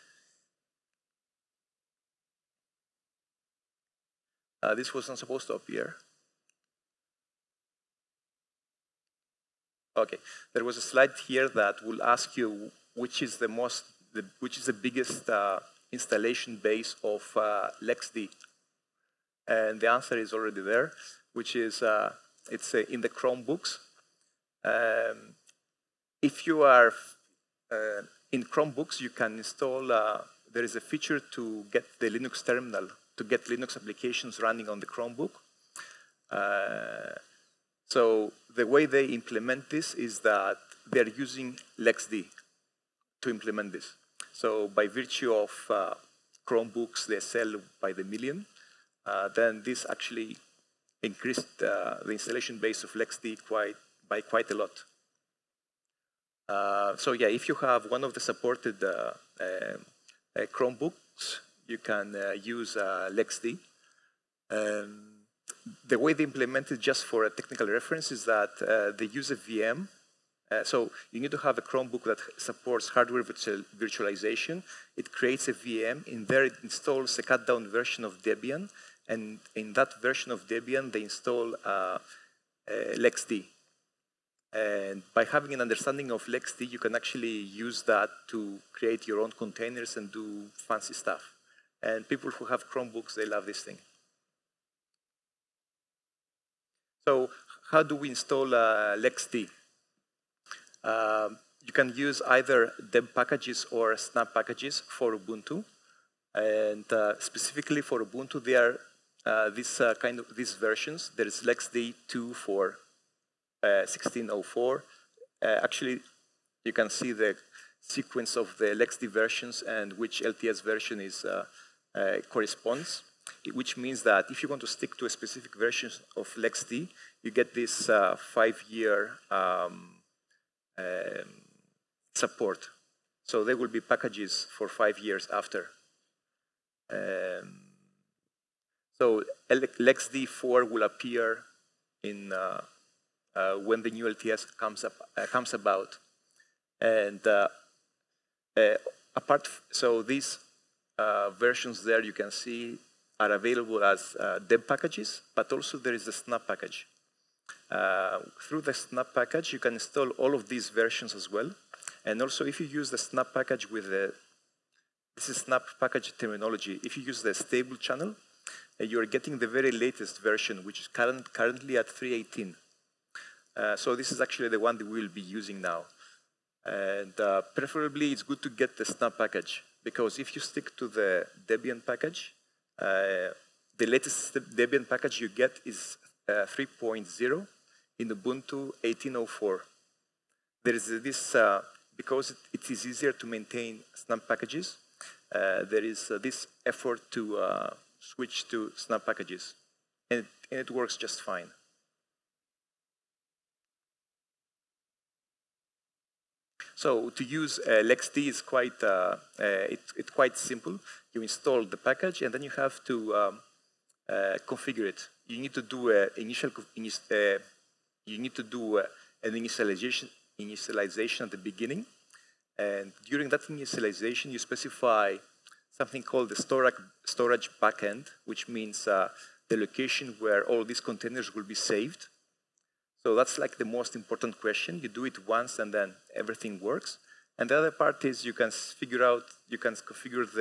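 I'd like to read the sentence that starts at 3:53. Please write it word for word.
So that's like the most important question.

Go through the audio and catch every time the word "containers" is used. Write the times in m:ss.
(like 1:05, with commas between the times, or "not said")
1:29, 3:50.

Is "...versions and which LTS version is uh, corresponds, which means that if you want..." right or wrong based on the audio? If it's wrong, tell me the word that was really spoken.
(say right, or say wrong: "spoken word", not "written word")
right.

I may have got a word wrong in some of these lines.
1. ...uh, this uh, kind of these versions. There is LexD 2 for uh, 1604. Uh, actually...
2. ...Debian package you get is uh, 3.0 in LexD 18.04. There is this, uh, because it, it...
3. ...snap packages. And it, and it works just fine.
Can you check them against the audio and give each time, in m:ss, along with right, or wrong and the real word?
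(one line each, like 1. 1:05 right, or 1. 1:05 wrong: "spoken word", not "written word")
1. 1:49 right
2. 3:04 wrong: "Ubuntu", not "LexD"
3. 3:18 right.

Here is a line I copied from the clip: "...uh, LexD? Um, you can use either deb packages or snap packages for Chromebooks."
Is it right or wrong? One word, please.
wrong.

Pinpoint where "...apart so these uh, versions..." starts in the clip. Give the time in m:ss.
2:29.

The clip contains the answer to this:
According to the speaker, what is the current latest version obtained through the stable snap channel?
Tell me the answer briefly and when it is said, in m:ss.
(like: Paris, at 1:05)
3.18, at 2:51.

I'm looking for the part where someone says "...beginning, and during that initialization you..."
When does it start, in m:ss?
3:41.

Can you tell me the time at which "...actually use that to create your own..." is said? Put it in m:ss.
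1:26.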